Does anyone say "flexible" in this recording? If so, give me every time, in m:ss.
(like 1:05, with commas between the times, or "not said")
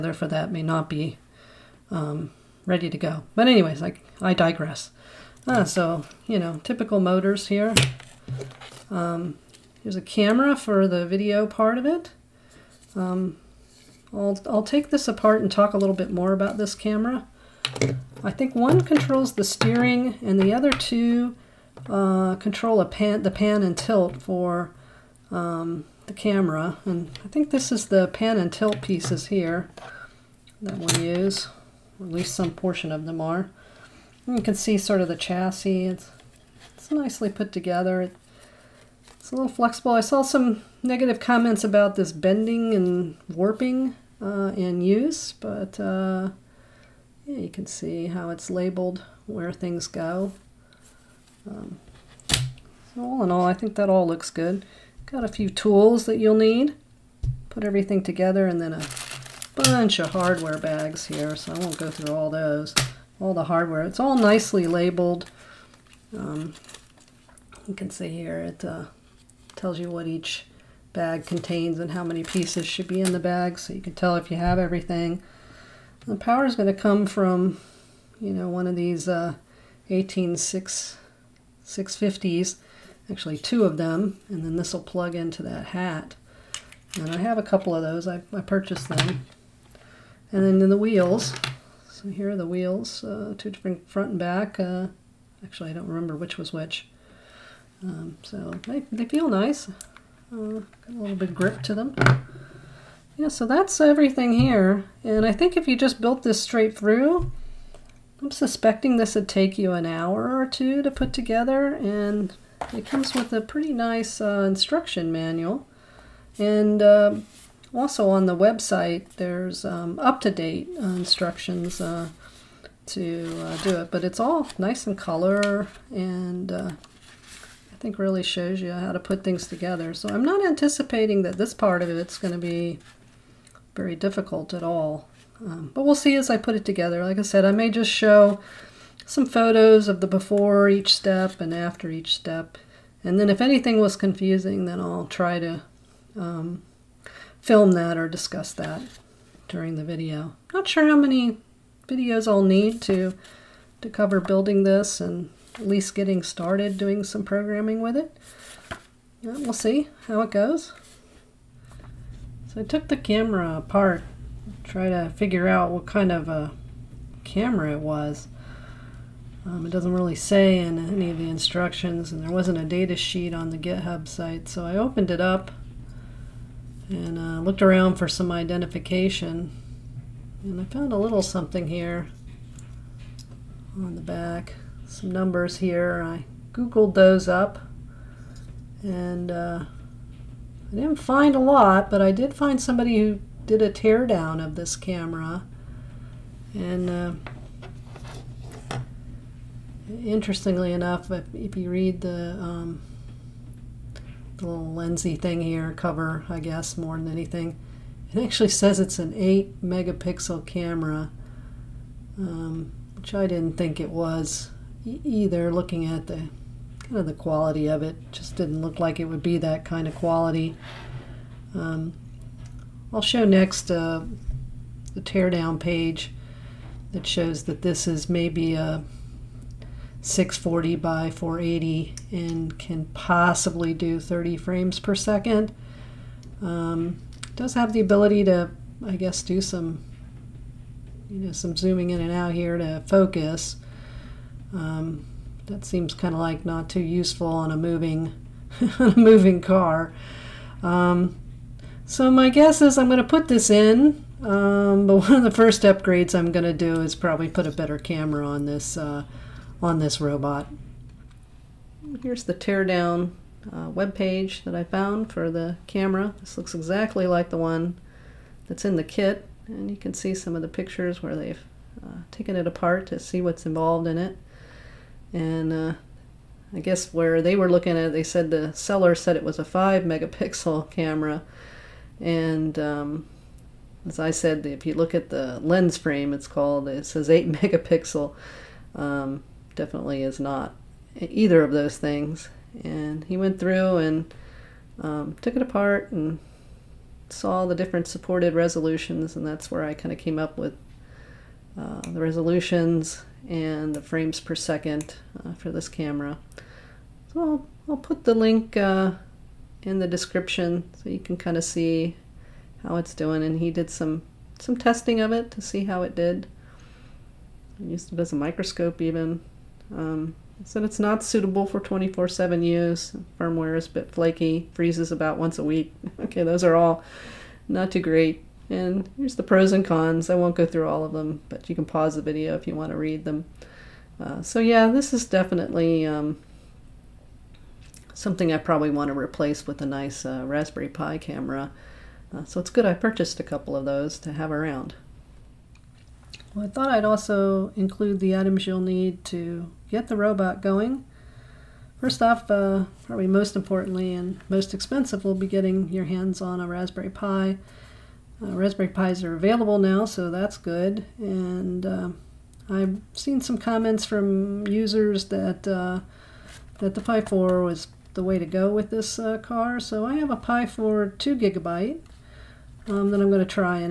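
0:39.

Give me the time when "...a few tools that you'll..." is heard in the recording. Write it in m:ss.
0:55.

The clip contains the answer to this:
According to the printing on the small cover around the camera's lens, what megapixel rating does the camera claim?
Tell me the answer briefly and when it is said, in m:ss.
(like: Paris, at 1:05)
8 megapixel, at 3:29.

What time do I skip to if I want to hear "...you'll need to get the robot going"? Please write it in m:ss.
5:48.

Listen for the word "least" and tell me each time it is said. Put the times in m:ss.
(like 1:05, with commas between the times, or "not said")
0:32, 2:35.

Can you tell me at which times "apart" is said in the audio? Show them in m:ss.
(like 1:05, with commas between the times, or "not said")
0:15, 2:43, 4:32, 4:55.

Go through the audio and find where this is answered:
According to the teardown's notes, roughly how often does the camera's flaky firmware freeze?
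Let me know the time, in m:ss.
5:25.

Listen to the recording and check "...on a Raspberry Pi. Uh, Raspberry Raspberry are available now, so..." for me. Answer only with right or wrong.
wrong.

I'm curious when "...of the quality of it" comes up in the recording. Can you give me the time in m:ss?
3:36.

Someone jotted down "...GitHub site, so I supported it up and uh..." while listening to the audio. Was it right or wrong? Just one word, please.
wrong.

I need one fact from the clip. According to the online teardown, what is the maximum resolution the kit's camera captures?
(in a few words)
640 by 480.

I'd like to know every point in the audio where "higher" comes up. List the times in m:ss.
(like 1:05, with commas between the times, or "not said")
not said.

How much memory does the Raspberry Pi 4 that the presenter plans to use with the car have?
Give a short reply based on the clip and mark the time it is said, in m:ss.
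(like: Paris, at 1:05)
2 gigabytes, at 6:10.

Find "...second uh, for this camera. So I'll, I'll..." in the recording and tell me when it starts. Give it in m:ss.
5:04.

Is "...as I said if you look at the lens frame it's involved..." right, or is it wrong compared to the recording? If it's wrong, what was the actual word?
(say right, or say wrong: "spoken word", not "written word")
wrong: "called", not "involved".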